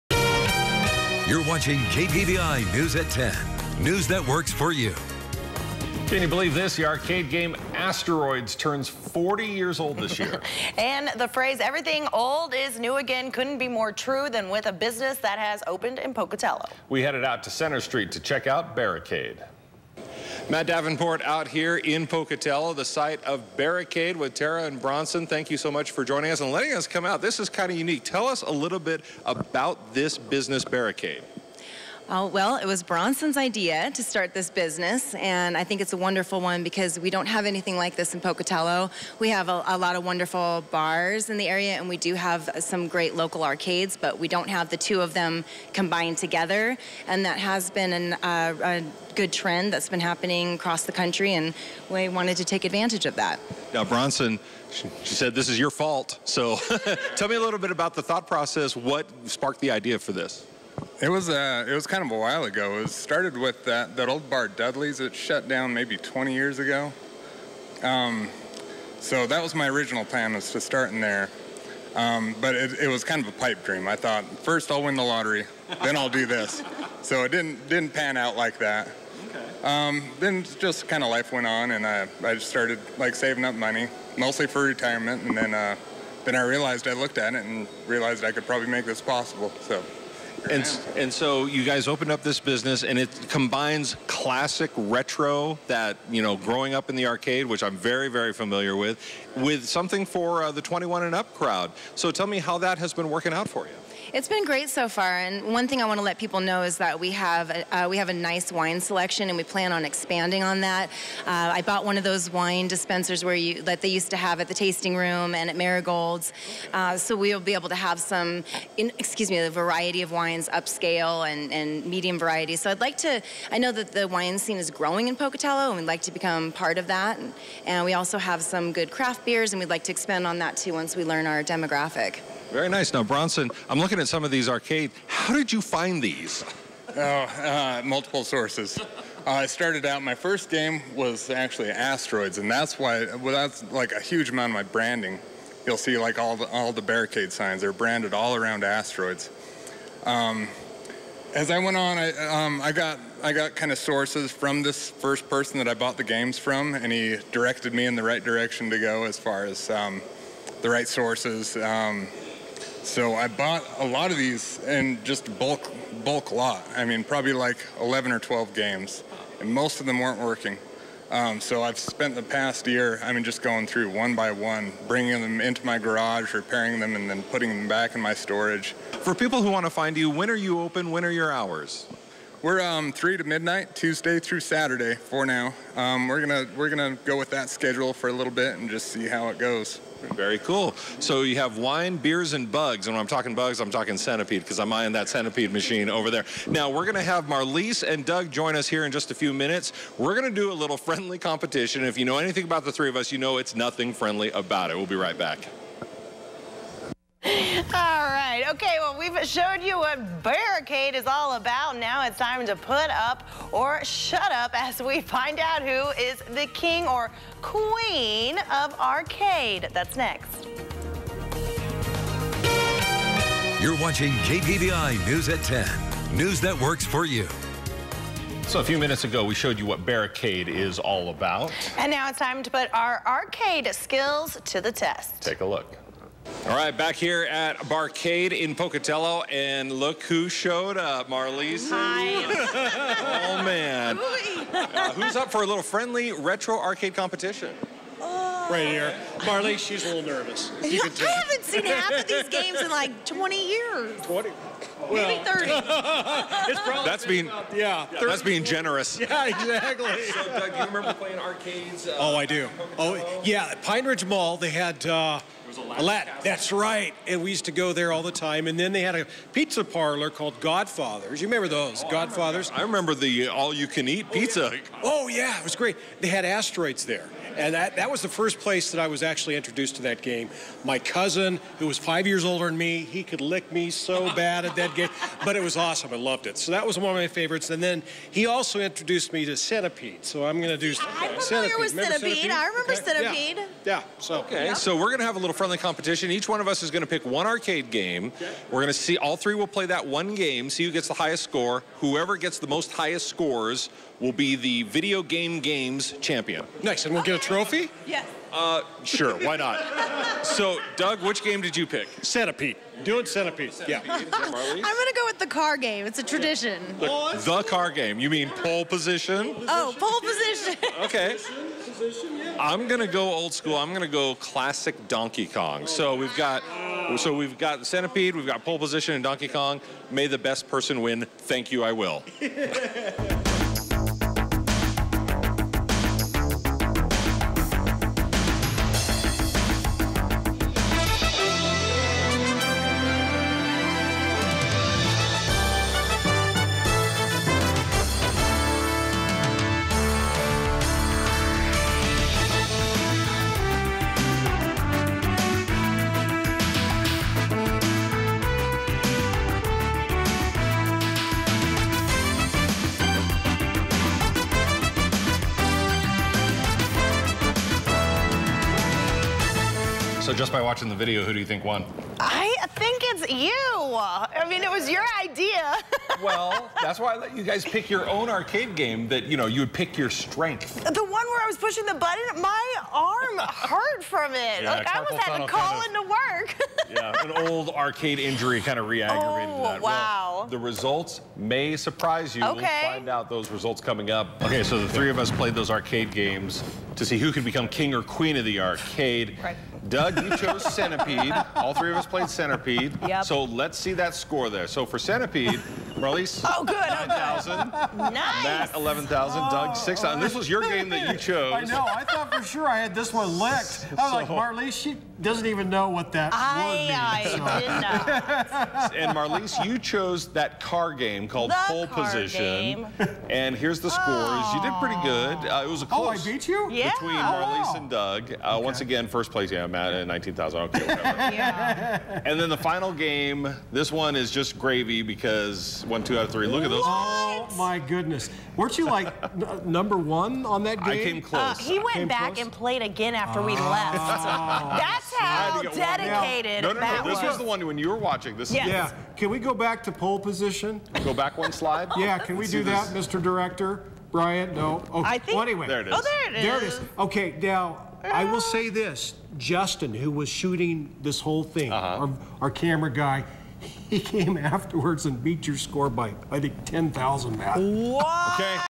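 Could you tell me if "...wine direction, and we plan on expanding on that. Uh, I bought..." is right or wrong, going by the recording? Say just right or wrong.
wrong.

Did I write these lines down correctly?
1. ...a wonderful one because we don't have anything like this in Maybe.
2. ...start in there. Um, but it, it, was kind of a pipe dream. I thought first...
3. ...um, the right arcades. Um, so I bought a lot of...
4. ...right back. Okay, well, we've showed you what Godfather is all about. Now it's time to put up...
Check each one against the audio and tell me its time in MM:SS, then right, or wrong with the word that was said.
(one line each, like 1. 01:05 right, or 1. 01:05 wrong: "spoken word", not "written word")
1. 00:35 wrong: "Pocatello", not "Maybe"
2. 01:10 right
3. 02:39 wrong: "sources", not "arcades"
4. 03:24 wrong: "Barricade", not "Godfather".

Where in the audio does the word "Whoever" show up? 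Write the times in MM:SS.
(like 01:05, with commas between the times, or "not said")
05:01.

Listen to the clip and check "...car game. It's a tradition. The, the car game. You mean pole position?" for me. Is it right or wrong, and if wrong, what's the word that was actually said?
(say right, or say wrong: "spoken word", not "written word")
right.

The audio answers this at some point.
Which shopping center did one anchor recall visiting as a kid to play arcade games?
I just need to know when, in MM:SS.
04:23.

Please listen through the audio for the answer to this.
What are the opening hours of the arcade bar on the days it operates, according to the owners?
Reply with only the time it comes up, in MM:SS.
03:02.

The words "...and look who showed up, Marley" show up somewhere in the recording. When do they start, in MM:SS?
03:59.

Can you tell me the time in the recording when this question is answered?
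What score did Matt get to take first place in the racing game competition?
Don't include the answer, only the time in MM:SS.
07:09.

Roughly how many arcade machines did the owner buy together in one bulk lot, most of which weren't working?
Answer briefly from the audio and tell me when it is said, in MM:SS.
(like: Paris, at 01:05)
11 or 12, at 02:47.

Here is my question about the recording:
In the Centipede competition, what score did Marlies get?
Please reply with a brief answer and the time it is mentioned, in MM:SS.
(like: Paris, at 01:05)
9,000, at 06:46.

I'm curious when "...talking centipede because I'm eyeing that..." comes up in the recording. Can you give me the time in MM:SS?
03:13.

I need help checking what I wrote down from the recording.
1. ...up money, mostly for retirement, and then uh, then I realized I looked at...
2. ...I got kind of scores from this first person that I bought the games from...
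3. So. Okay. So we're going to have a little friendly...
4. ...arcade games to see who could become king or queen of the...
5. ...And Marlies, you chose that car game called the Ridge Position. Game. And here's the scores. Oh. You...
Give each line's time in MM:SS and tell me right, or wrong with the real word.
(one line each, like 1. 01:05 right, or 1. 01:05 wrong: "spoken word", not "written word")
1. 01:23 right
2. 02:33 wrong: "sources", not "scores"
3. 04:53 right
4. 06:35 right
5. 06:58 wrong: "Pole", not "Ridge".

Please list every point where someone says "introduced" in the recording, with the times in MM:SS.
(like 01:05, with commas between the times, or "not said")
04:39, 04:48.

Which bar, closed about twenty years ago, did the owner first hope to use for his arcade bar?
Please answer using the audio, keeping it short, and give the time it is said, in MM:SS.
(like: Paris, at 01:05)
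Dudley's, at 01:04.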